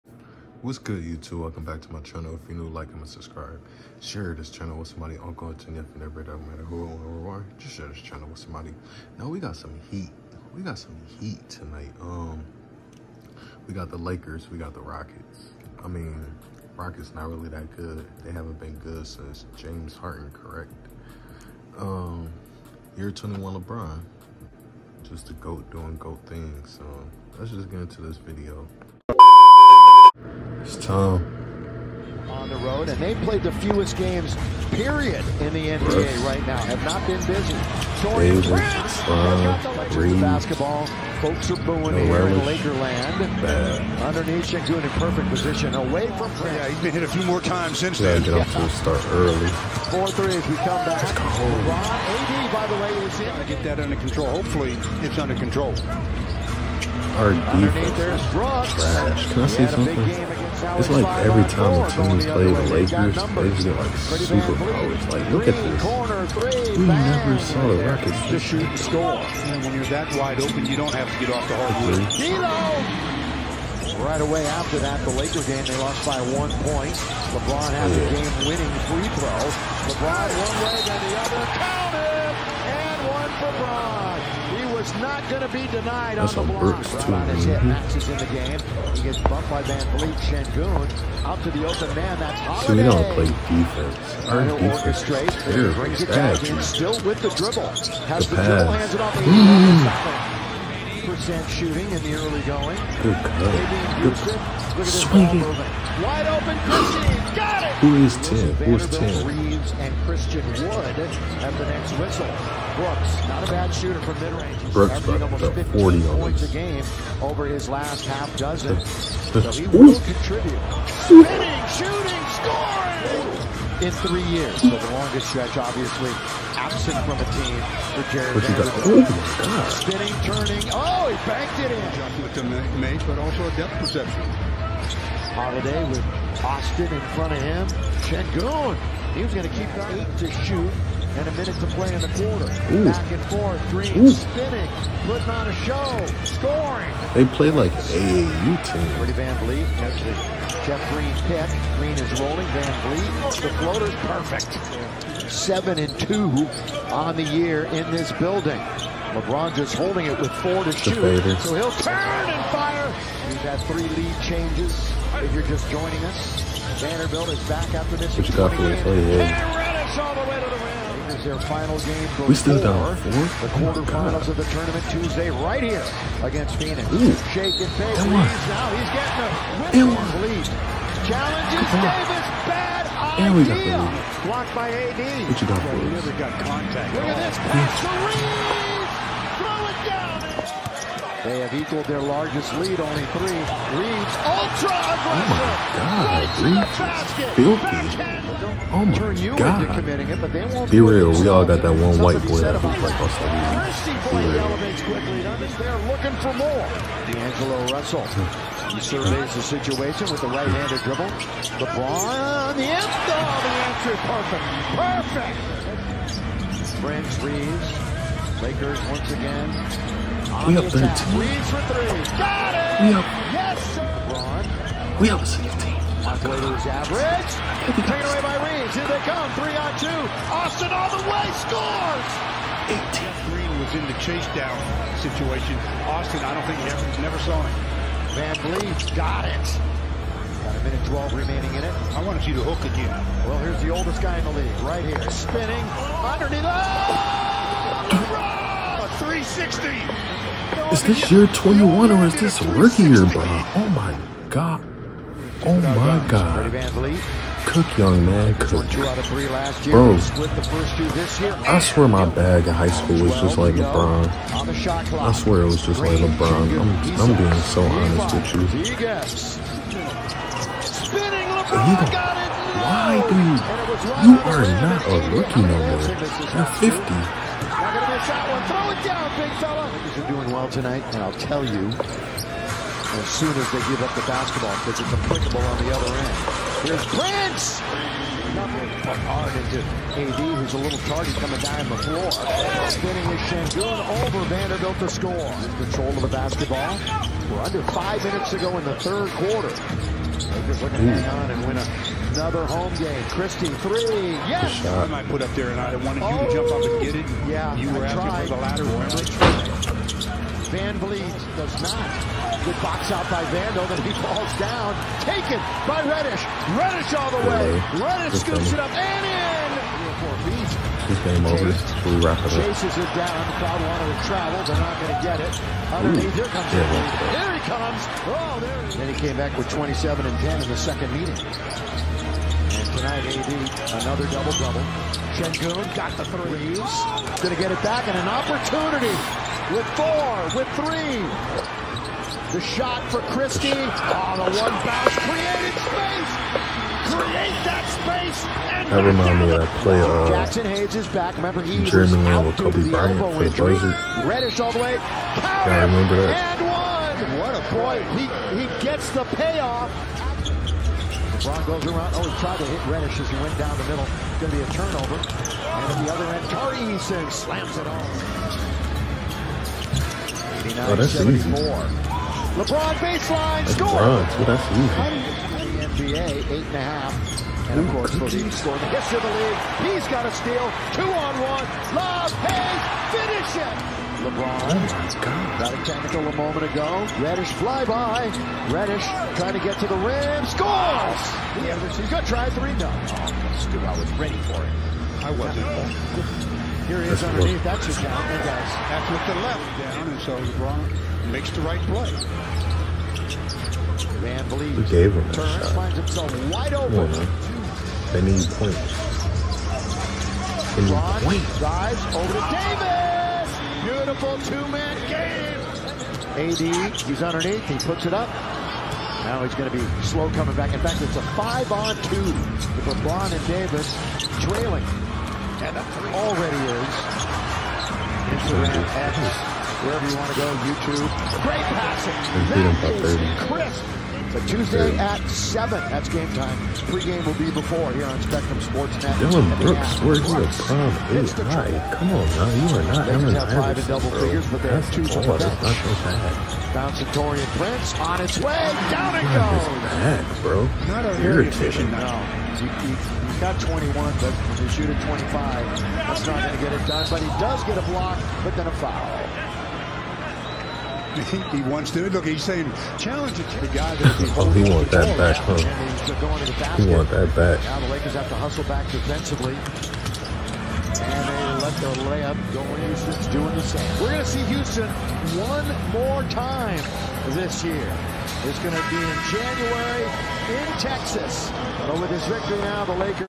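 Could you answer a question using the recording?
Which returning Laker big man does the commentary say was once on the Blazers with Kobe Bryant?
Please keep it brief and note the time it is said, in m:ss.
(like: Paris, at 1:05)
Jaxson Hayes, at 5:50.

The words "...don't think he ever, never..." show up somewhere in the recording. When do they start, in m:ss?
3:56.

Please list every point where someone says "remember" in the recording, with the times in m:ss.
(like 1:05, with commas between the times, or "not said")
5:08, 5:51, 5:55.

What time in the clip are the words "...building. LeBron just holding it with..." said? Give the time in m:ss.
2:38.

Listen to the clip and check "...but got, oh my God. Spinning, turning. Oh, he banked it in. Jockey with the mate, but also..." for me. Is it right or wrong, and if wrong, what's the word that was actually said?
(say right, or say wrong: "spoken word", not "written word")
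right.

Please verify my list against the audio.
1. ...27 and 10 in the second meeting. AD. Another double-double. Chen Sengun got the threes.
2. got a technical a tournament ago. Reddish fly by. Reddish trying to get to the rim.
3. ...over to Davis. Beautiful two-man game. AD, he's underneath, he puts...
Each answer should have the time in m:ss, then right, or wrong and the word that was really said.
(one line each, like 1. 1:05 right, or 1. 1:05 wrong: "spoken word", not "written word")
1. 5:29 right
2. 6:25 wrong: "moment", not "tournament"
3. 6:51 right.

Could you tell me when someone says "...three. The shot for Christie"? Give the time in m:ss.
5:40.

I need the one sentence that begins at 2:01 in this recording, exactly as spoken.
Spinning, shooting, scoring in three years.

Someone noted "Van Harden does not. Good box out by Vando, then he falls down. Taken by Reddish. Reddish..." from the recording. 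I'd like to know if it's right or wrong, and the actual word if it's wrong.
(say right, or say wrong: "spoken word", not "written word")
wrong: "Vliet", not "Harden".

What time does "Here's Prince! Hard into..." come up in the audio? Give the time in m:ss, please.
4:46.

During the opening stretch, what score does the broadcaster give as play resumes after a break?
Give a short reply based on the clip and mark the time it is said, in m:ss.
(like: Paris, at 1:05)
4-3, at 0:49.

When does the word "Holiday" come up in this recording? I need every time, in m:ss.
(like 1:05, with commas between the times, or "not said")
1:32, 2:15.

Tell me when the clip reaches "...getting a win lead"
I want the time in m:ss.
2:59.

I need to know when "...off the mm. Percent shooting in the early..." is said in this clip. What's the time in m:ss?
1:39.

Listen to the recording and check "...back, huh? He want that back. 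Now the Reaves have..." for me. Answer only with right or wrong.
wrong.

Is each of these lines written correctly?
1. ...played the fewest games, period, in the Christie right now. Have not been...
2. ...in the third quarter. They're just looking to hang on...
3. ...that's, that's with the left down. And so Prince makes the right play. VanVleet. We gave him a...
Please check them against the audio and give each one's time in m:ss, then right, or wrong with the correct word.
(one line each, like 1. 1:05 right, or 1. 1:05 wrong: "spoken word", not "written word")
1. 0:33 wrong: "NBA", not "Christie"
2. 4:58 right
3. 6:38 wrong: "LeBron", not "Prince".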